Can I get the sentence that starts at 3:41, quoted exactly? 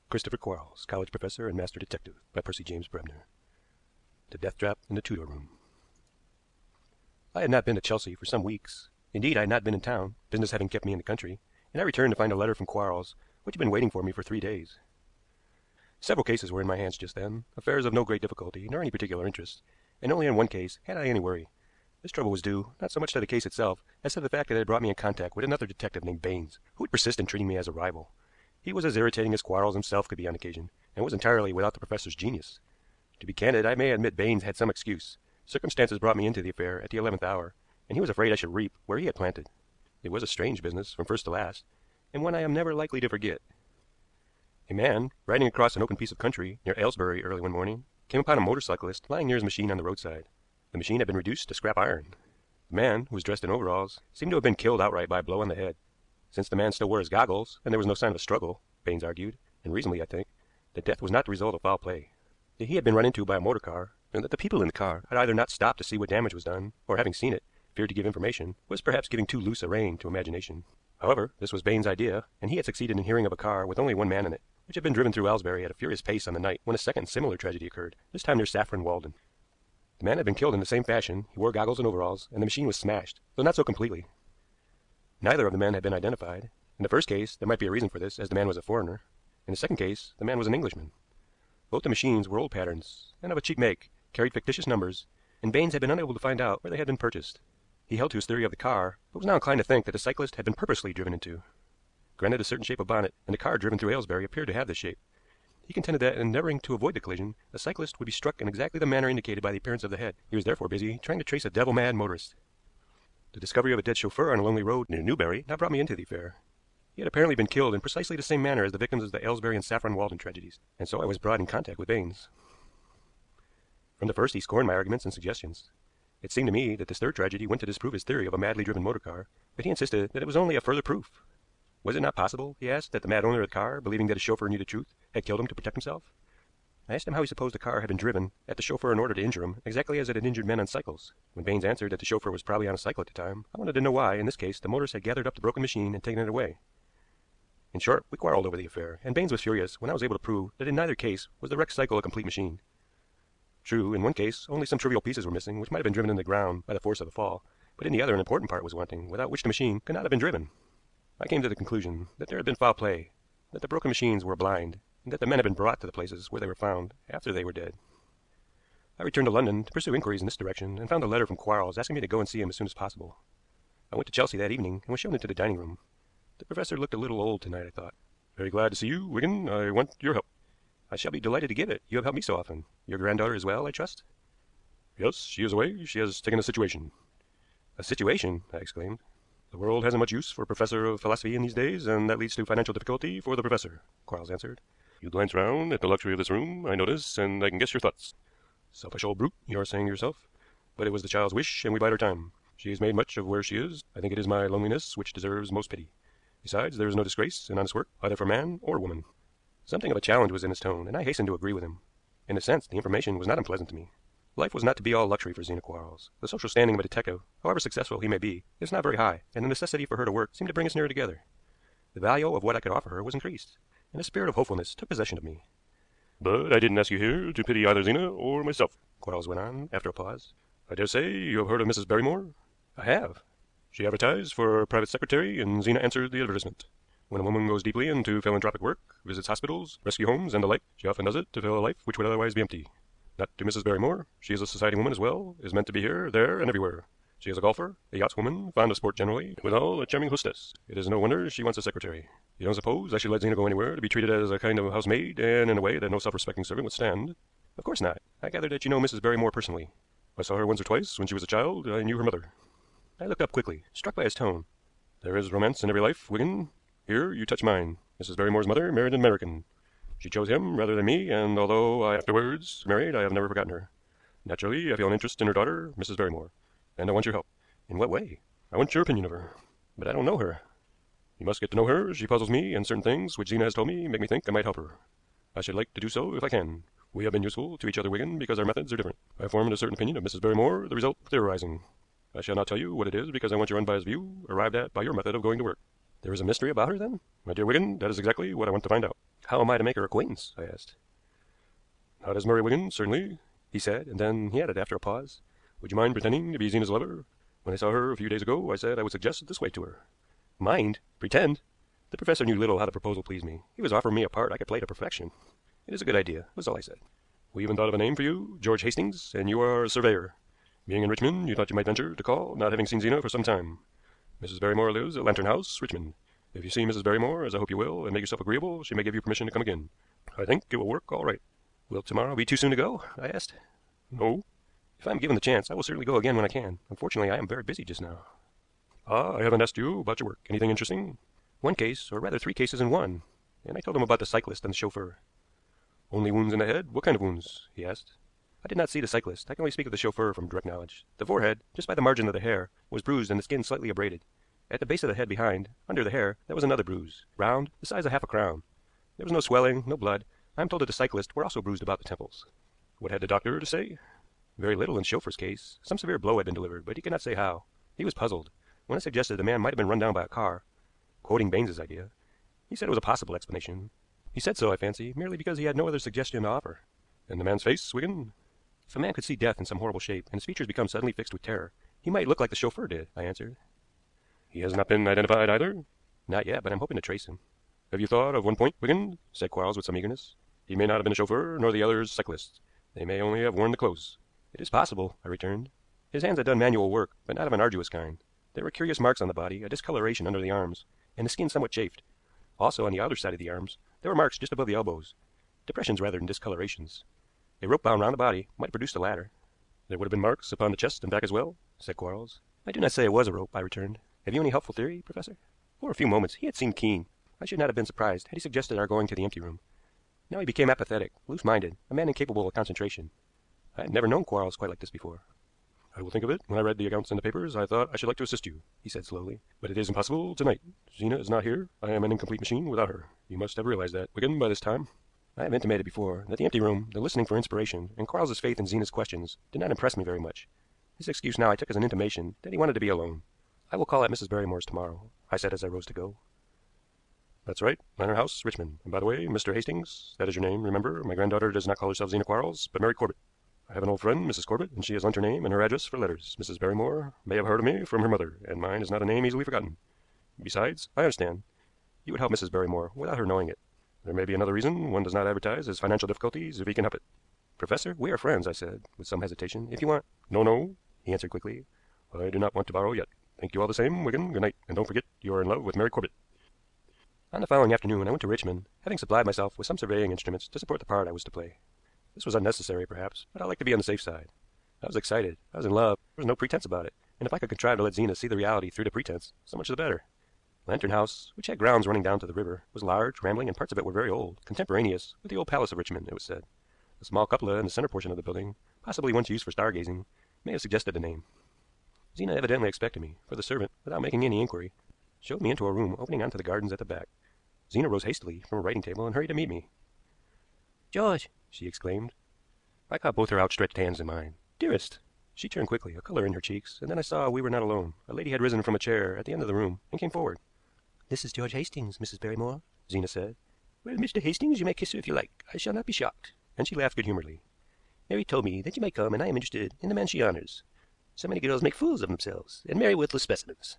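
The value of what I could offer her was increased, and a spirit of hopefulness took possession of me.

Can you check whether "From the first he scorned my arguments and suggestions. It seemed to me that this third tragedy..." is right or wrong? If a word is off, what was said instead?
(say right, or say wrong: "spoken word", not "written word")
right.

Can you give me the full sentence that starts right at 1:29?
In the second case the man was an Englishman.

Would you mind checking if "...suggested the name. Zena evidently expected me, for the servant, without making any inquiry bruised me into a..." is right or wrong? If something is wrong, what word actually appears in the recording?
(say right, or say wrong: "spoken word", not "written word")
wrong: "showed", not "bruised".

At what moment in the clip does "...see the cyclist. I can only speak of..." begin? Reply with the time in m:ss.
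5:48.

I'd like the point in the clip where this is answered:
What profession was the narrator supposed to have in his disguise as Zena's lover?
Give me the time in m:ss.
5:19.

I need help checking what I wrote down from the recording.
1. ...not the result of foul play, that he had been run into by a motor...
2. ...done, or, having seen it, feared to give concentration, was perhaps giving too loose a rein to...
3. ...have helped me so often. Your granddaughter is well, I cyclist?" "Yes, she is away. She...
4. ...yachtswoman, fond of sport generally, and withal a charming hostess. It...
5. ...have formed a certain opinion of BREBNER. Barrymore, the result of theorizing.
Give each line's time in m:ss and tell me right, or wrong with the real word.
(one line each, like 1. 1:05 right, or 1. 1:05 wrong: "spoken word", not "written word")
1. 1:01 right
2. 1:06 wrong: "information", not "concentration"
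3. 3:01 wrong: "trust", not "cyclist"
4. 4:07 right
5. 4:49 wrong: "Mrs", not "BREBNER".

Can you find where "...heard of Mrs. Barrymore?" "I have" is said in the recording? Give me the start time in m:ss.
3:51.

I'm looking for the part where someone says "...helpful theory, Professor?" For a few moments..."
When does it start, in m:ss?
6:54.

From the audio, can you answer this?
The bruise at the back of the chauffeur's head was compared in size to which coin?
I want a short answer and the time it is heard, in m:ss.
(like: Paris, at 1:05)
half a crown, at 5:57.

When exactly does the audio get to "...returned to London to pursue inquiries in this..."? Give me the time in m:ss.
2:49.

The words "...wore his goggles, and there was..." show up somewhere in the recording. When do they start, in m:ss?
0:56.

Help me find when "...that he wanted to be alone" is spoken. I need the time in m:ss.
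7:22.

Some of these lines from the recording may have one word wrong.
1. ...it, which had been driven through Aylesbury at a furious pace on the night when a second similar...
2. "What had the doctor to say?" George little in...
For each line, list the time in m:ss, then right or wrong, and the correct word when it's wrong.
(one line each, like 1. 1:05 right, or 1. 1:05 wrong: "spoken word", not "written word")
1. 1:14 right
2. 6:02 wrong: "Very", not "George".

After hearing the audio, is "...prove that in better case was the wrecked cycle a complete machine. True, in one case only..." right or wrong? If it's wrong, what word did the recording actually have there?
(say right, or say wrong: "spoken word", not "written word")
wrong: "neither", not "better".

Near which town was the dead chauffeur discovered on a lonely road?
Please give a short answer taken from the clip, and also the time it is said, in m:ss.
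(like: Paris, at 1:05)
Newbury, at 1:55.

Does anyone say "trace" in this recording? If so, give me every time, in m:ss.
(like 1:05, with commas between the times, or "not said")
1:51, 6:26.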